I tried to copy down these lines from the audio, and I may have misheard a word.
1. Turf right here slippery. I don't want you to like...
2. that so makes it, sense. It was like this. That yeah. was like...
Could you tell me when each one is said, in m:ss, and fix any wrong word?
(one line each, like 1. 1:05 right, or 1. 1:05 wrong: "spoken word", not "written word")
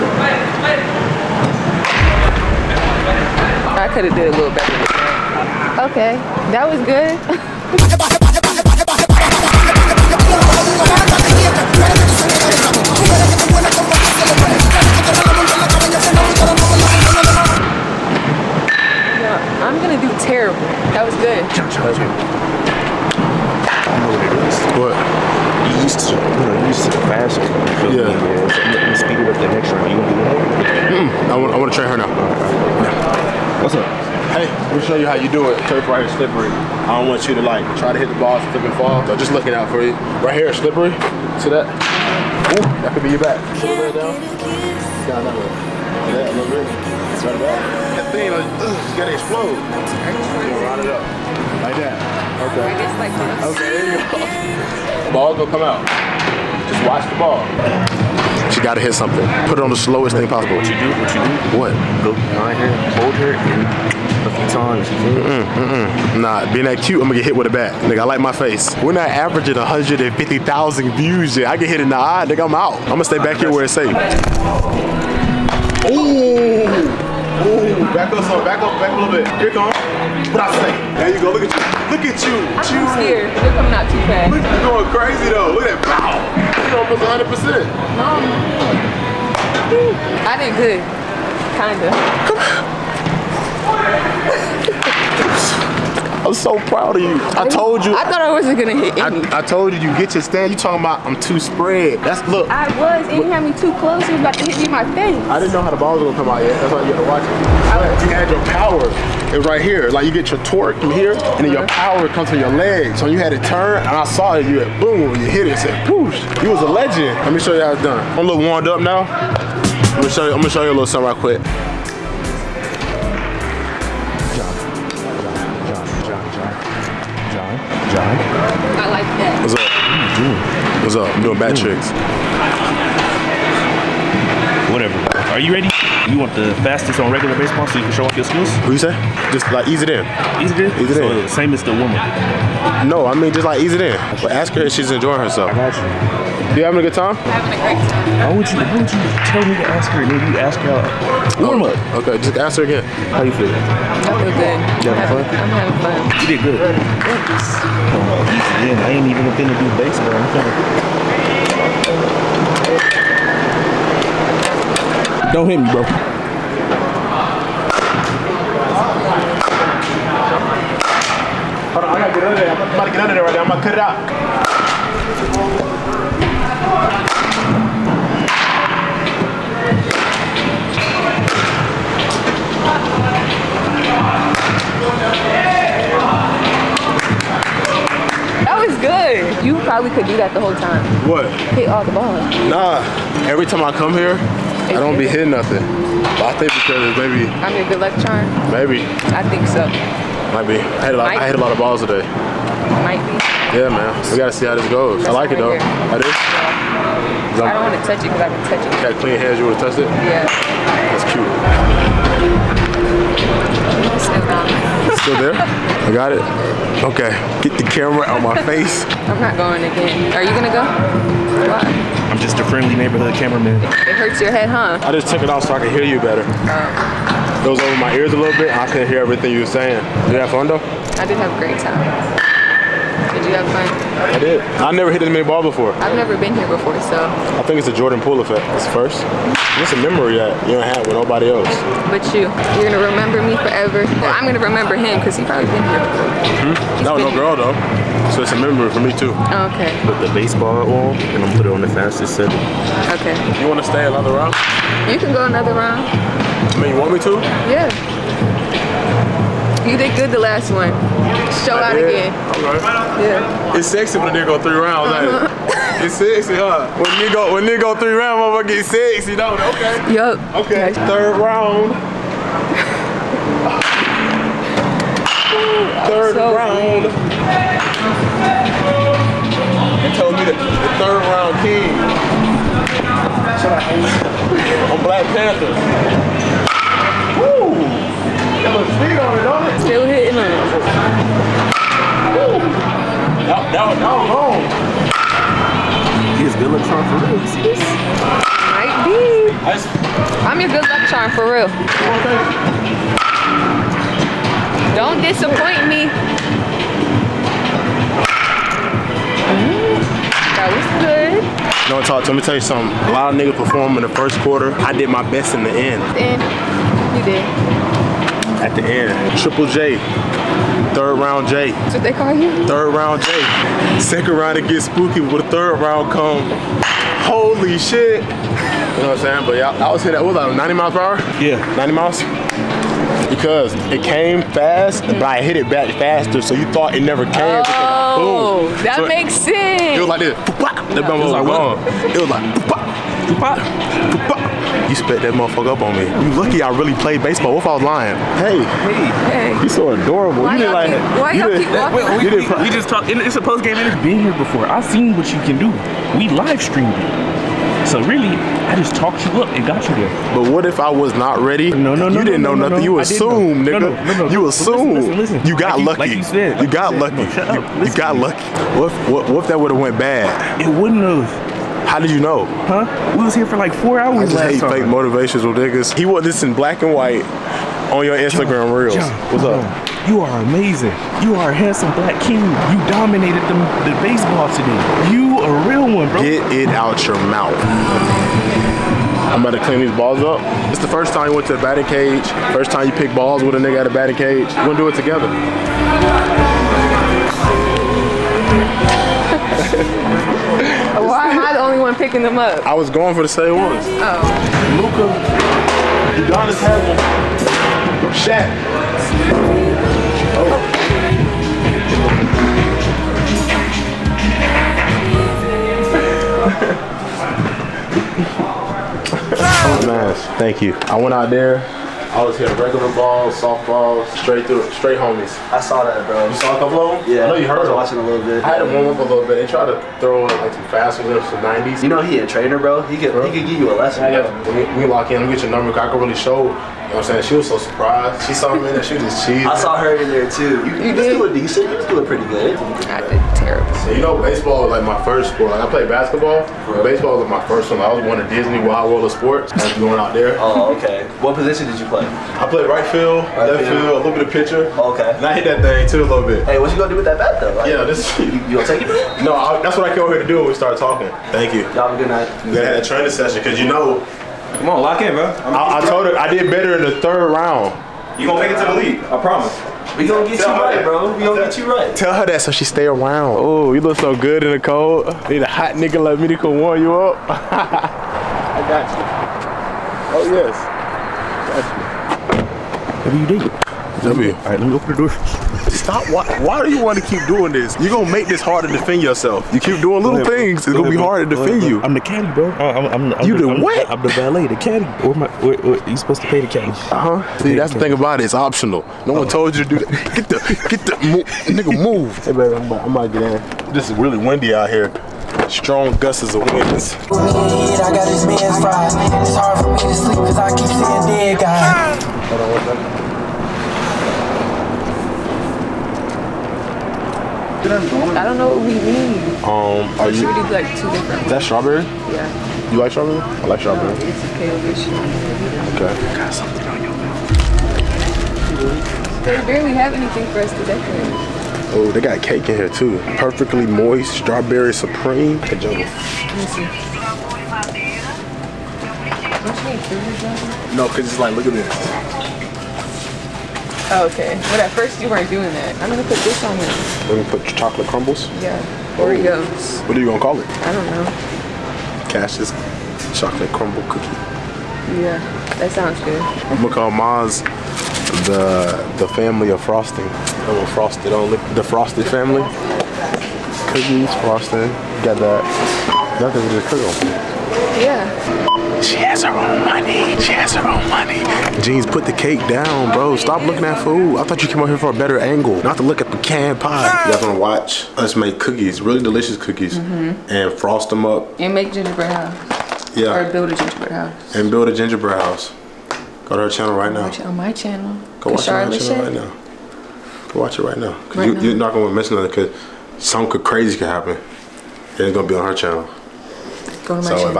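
1. 0:35 right
2. 5:38 right.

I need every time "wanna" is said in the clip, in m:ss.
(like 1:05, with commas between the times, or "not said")
4:13, 9:37.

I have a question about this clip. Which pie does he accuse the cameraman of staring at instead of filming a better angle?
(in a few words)
Pecan pie.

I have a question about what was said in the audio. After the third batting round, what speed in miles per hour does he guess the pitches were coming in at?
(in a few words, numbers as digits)
90.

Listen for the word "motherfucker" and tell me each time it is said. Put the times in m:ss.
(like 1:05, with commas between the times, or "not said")
4:28, 5:45.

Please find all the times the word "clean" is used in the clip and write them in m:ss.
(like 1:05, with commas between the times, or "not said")
3:28, 6:29.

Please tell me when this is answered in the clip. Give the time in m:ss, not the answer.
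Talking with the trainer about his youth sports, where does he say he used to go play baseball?
7:28.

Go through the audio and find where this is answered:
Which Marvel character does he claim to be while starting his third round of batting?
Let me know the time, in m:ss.
4:44.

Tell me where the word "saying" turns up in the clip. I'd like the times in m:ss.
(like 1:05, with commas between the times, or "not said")
3:49, 5:28, 7:16.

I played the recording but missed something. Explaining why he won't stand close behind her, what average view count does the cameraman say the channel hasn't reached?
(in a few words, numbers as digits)
150,000.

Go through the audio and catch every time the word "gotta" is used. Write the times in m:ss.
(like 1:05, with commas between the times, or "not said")
0:58, 2:51, 3:24.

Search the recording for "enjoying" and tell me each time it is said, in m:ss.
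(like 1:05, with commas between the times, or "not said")
2:24.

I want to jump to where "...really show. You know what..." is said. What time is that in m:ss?
7:15.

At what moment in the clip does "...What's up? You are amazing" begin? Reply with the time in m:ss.
6:19.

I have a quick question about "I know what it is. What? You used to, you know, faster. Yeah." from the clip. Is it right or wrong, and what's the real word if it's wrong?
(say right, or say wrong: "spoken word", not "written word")
right.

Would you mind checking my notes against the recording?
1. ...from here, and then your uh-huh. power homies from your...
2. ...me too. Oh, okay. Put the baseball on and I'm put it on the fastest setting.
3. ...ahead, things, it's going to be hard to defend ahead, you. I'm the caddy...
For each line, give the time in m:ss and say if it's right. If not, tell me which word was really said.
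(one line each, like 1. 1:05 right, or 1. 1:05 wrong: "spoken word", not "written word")
1. 1:50 wrong: "comes", not "homies"
2. 4:08 right
3. 8:10 right.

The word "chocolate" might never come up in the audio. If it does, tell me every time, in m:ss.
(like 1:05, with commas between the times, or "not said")
9:07, 9:12.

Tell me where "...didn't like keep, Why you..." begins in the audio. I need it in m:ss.
5:50.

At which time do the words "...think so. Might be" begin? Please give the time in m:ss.
3:19.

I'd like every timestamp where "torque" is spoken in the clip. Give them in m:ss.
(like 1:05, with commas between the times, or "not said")
1:50.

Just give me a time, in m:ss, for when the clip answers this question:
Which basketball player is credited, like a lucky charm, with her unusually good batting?
3:57.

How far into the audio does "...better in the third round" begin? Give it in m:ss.
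7:46.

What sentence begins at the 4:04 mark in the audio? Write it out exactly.
Well, I'm gonna remember him because he probably been here before.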